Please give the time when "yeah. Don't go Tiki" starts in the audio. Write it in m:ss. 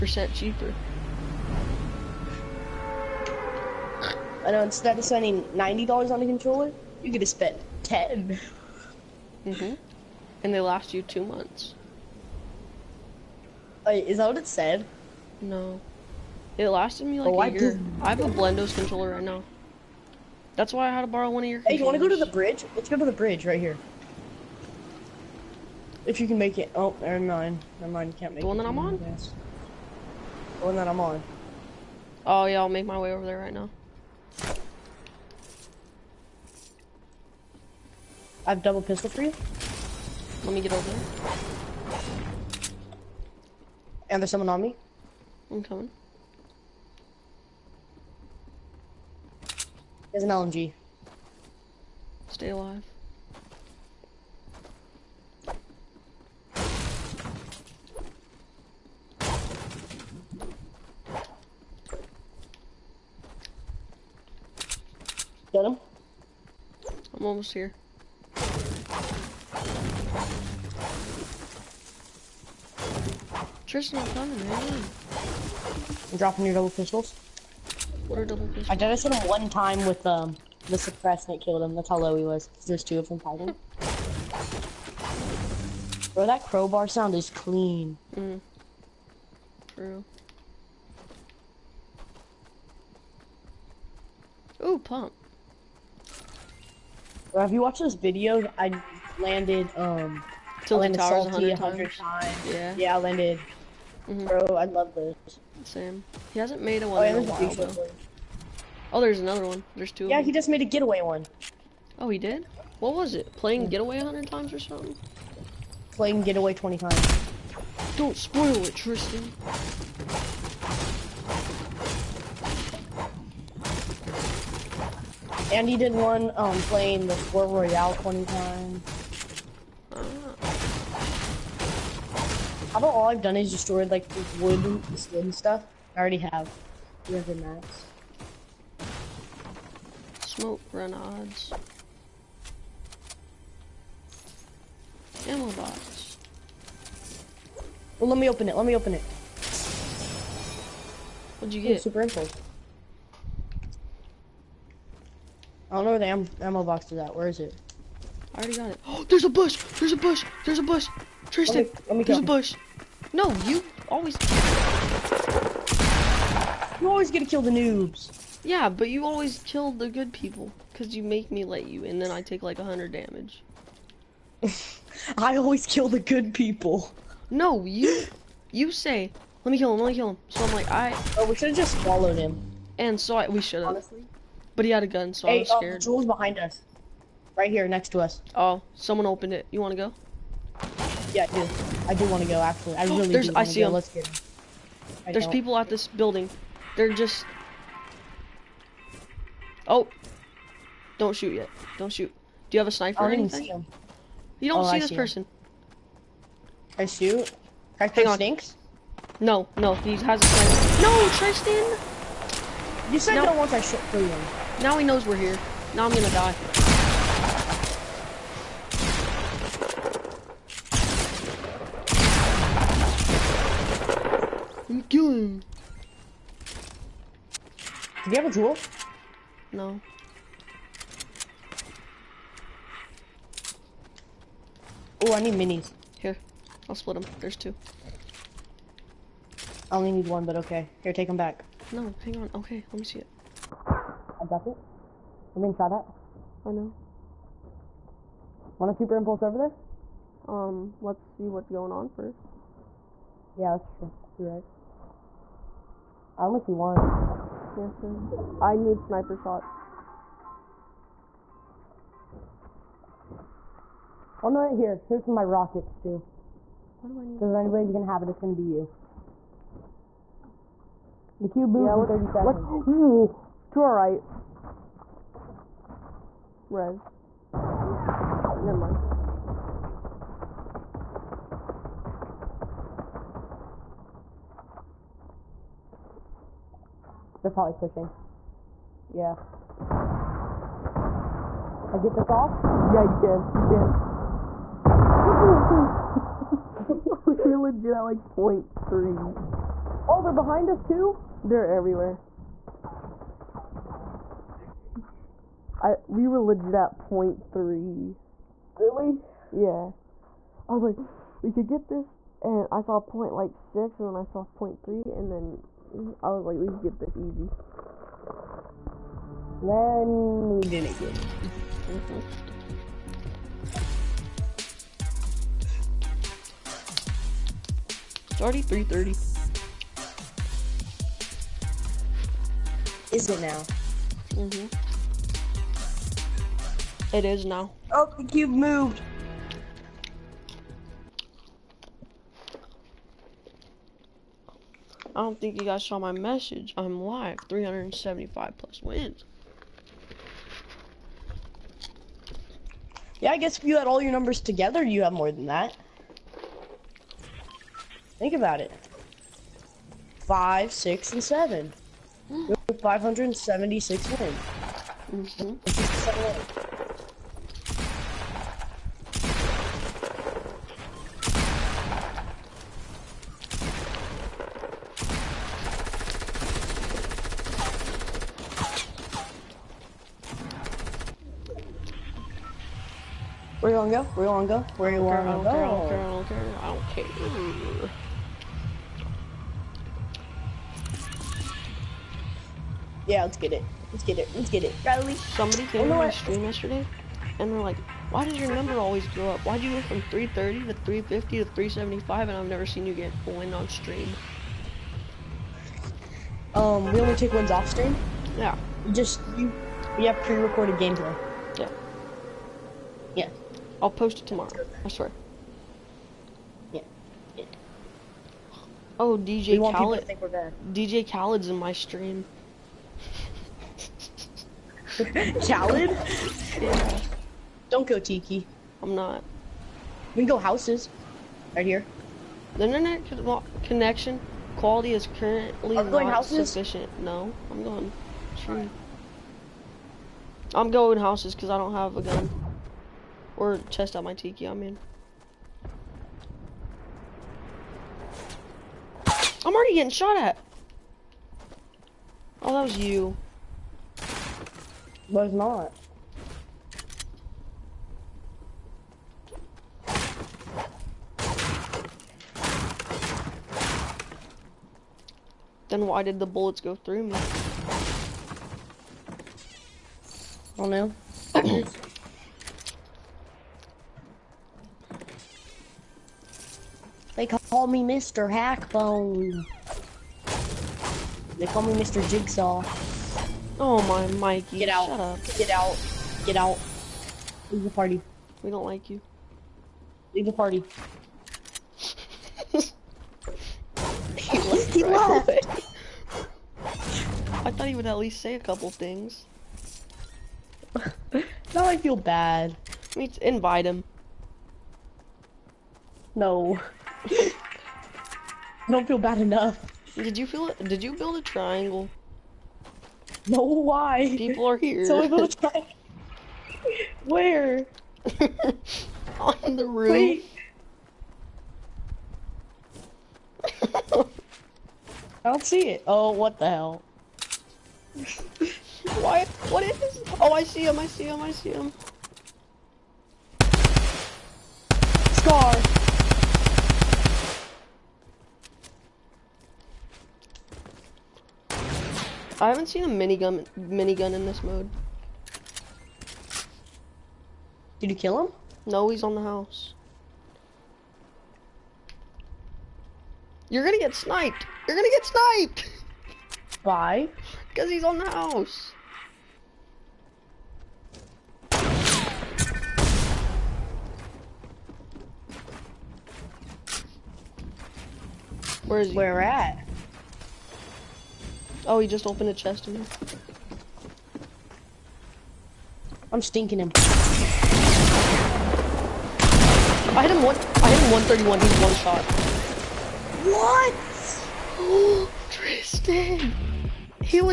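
7:06.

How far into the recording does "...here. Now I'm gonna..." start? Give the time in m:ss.
3:35.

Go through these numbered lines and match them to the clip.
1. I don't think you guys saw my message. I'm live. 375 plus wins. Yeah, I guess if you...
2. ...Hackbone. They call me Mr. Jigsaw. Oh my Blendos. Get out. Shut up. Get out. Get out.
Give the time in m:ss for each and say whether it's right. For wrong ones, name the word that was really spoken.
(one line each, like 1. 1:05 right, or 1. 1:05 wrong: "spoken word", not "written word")
1. 5:44 right
2. 7:58 wrong: "Mikey", not "Blendos".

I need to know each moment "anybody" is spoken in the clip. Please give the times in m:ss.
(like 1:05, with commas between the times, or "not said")
4:27.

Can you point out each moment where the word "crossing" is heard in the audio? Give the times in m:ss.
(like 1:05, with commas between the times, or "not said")
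not said.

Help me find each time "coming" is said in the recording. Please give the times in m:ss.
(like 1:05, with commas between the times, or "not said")
0:45, 1:14.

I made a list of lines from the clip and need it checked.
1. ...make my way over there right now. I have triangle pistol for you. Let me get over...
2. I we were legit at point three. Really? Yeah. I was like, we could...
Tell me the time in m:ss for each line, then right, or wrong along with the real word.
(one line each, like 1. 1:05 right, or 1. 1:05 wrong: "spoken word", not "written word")
1. 0:32 wrong: "double", not "triangle"
2. 5:05 right.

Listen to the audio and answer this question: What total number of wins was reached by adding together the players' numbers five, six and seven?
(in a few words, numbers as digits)
576.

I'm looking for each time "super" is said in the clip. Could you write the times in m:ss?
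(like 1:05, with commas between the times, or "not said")
2:31, 4:08.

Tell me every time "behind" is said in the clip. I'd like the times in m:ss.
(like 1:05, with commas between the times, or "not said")
3:06, 5:00.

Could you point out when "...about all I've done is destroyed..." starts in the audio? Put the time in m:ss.
2:12.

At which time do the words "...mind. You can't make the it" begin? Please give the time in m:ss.
0:27.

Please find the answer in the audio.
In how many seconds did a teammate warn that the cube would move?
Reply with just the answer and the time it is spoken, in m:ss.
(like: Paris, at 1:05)
30, at 4:31.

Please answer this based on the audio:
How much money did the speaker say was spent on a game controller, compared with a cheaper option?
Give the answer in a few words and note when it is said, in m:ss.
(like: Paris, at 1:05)
$90, at 0:05.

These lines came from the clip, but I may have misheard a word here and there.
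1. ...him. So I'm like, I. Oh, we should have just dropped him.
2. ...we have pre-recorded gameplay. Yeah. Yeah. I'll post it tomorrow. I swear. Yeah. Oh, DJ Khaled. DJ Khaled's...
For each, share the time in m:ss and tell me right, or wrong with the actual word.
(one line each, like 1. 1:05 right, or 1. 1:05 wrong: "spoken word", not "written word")
1. 3:00 wrong: "followed", not "dropped"
2. 6:49 right.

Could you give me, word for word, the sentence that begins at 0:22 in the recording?
Let's go to the bridge right here.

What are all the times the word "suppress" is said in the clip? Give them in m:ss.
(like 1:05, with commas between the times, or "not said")
1:20.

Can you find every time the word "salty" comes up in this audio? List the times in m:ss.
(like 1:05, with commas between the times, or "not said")
1:40.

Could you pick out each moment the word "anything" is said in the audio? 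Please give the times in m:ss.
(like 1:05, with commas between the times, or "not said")
3:23.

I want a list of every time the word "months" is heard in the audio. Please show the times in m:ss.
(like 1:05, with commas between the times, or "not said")
0:11.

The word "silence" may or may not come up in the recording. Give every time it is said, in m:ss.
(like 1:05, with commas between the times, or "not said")
not said.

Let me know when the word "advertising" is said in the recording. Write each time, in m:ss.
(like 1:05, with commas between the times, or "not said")
not said.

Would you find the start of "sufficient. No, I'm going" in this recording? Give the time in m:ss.
7:16.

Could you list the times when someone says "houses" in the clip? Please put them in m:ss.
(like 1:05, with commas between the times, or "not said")
7:10, 7:15, 7:20, 9:09, 9:17.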